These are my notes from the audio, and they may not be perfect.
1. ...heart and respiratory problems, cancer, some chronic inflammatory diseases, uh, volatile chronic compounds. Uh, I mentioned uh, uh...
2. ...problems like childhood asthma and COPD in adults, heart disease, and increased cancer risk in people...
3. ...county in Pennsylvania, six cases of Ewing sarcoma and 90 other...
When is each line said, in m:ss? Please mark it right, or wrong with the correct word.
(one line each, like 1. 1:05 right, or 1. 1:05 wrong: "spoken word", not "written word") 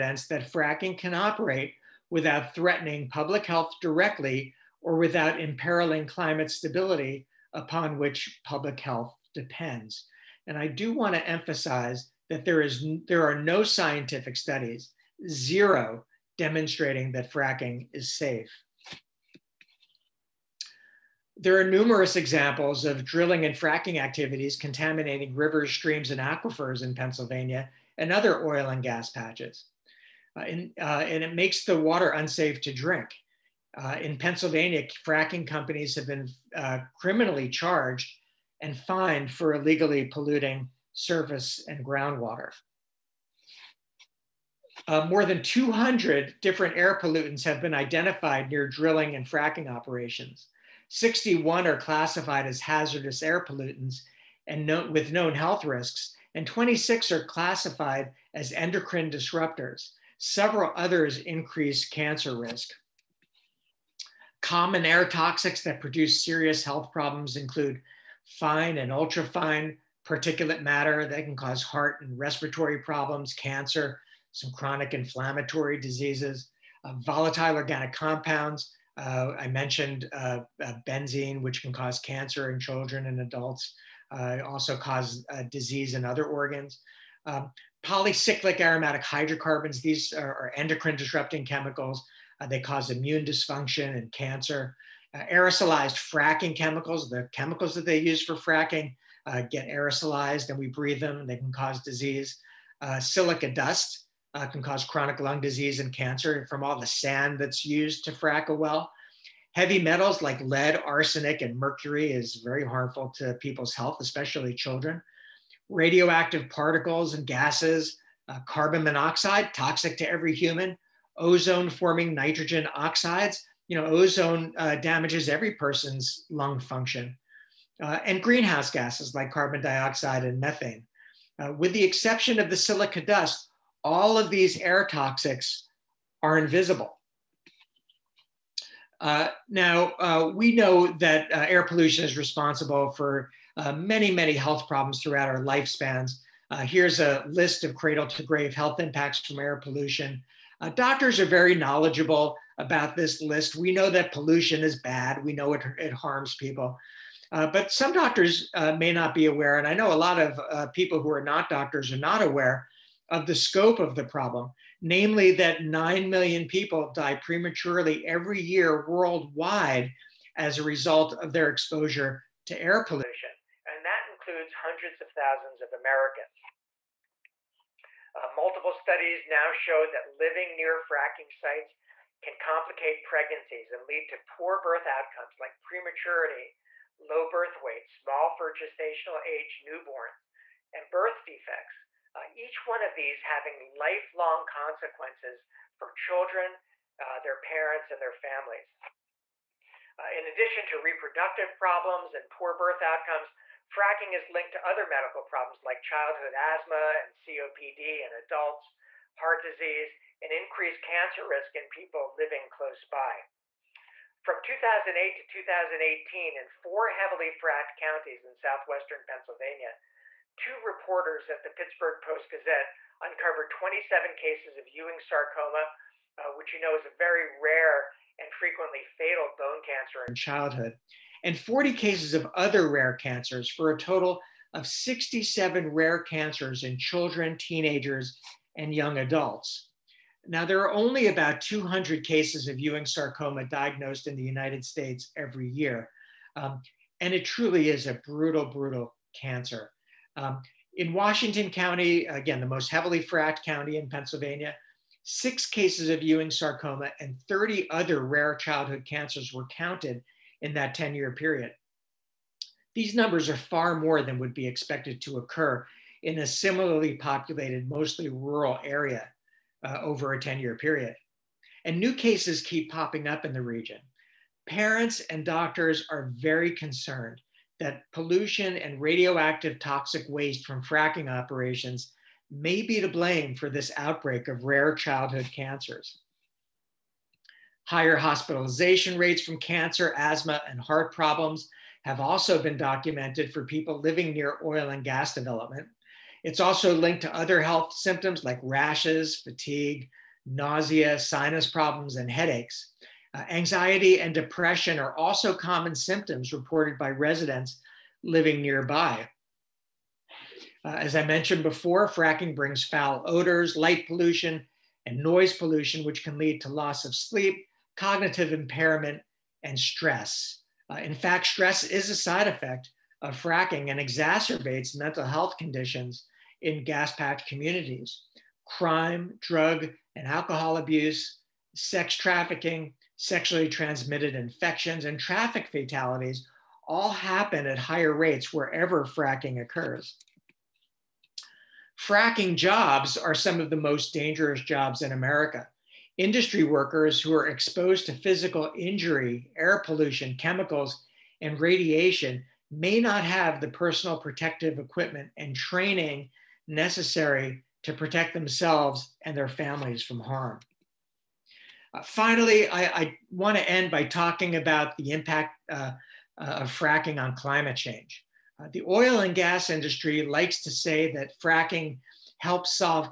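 1. 1:11 wrong: "organic", not "chronic"
2. 3:25 right
3. 4:13 wrong: "30", not "90".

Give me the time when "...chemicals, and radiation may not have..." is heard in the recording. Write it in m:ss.
5:50.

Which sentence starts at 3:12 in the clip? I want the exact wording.
Uh, each one of these having lifelong consequences for children, uh, their parents, and their families.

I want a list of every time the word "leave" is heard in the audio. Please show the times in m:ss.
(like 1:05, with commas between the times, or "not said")
not said.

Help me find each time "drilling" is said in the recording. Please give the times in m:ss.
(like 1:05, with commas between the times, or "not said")
0:23, 0:48.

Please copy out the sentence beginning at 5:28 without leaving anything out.
Crime, drug, and alcohol abuse, sex trafficking, sexually transmitted infections, and traffic fatalities all happen at higher rates wherever fracking occurs.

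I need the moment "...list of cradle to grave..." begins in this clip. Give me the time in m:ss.
2:27.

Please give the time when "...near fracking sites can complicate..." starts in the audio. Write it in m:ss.
3:00.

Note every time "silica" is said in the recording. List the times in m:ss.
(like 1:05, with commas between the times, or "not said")
1:42, 2:12.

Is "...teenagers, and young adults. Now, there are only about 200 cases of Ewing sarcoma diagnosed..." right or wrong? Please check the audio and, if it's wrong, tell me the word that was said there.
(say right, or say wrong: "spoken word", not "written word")
right.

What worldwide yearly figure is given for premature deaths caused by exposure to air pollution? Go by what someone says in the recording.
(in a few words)
9 million.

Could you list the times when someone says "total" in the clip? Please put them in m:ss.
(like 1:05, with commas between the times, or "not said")
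3:53.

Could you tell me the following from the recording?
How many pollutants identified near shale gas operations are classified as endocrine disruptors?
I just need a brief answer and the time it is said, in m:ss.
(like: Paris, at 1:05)
26, at 0:56.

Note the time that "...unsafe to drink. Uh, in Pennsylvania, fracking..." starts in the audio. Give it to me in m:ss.
0:32.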